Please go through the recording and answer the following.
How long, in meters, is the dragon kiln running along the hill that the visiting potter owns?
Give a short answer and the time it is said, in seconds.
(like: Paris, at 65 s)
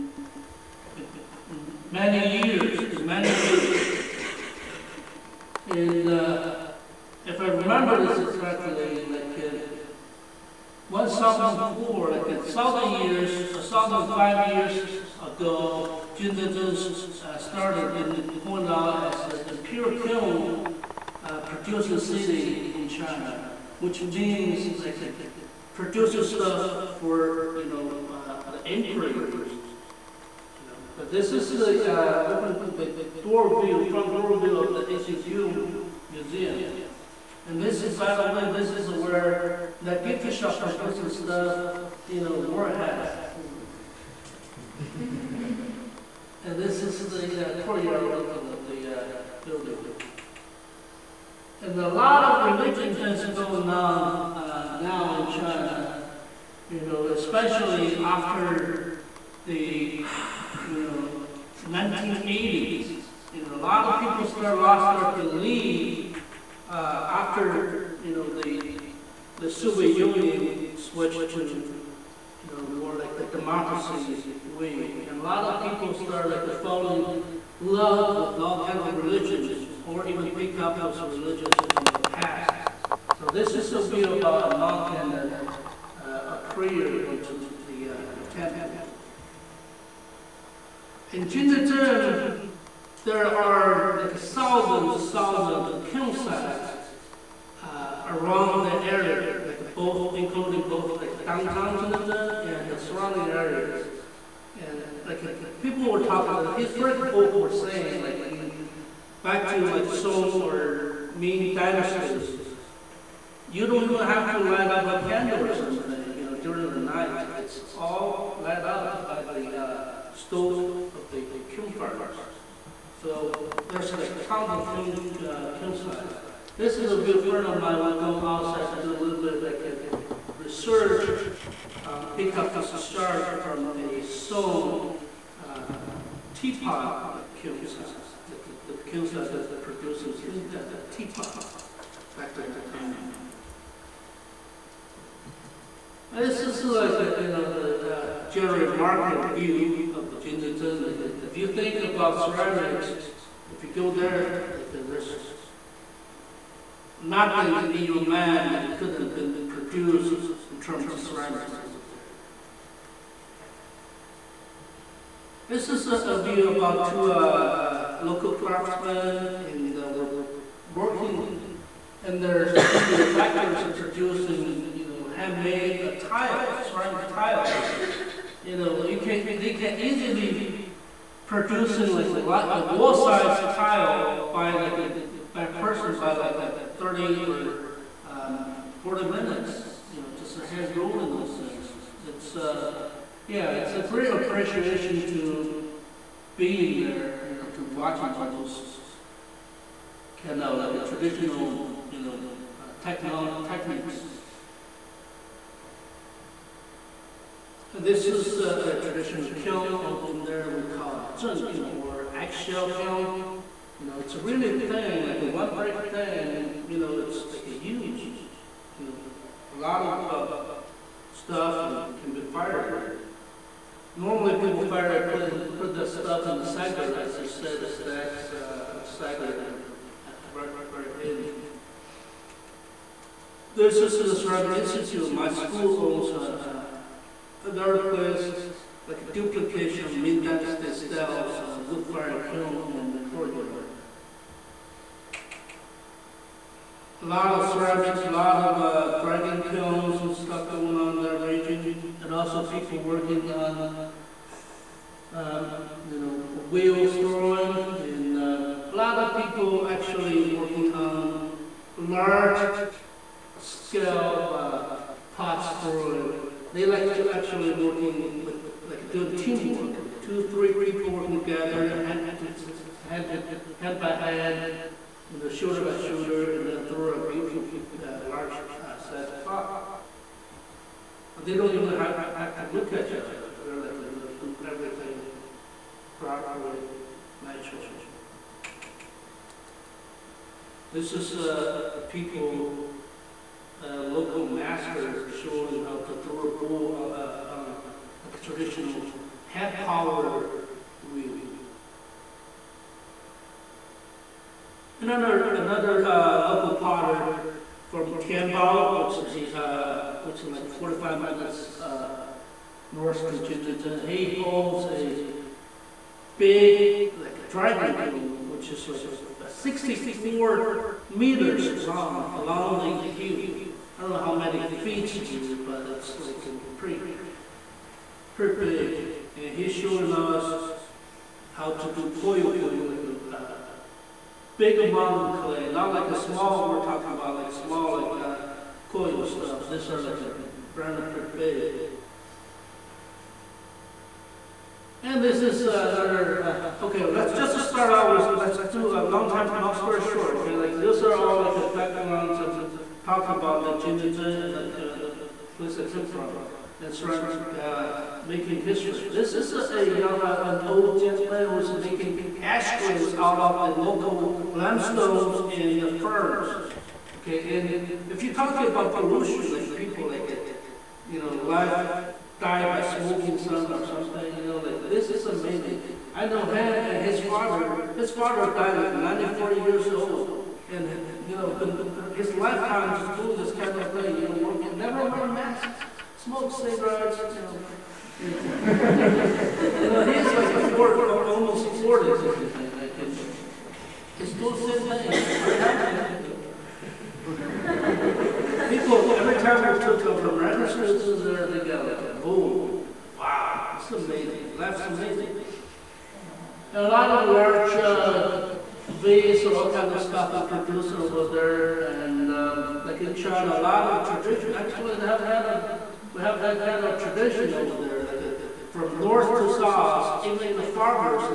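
64 meters, at 319 s.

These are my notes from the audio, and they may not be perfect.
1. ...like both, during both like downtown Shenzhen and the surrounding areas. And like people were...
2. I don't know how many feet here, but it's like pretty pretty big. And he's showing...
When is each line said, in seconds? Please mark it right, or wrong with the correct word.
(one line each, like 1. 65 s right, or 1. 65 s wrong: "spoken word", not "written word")
1. 99 s wrong: "including", not "during"
2. 323 s right.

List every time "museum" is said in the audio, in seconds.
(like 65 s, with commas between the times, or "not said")
36 s.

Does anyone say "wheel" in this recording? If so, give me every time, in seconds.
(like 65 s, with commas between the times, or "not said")
256 s, 300 s.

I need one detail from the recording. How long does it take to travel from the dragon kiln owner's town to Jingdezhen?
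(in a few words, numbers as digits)
45 minutes.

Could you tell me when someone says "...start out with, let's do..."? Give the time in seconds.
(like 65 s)
347 s.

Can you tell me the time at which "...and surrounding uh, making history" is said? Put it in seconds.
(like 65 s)
356 s.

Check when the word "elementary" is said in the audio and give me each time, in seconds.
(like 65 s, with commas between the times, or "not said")
not said.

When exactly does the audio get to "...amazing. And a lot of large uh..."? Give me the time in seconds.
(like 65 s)
404 s.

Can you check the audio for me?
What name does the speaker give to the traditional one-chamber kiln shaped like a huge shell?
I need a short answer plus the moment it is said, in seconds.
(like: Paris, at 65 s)
eggshell kiln, at 212 s.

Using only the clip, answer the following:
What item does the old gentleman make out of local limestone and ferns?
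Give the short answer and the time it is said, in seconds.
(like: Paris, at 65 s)
ashtrays, at 362 s.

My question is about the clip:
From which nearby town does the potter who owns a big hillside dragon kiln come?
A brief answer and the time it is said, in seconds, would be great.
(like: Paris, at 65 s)
Tianbao, at 307 s.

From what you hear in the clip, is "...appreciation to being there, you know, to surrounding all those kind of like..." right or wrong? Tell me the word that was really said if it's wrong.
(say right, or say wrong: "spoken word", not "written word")
wrong: "watching", not "surrounding".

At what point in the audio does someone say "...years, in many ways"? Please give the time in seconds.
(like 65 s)
2 s.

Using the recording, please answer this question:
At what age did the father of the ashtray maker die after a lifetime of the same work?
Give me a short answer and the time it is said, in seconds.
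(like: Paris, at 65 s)
94, at 378 s.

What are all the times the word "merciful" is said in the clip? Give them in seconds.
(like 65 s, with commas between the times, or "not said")
not said.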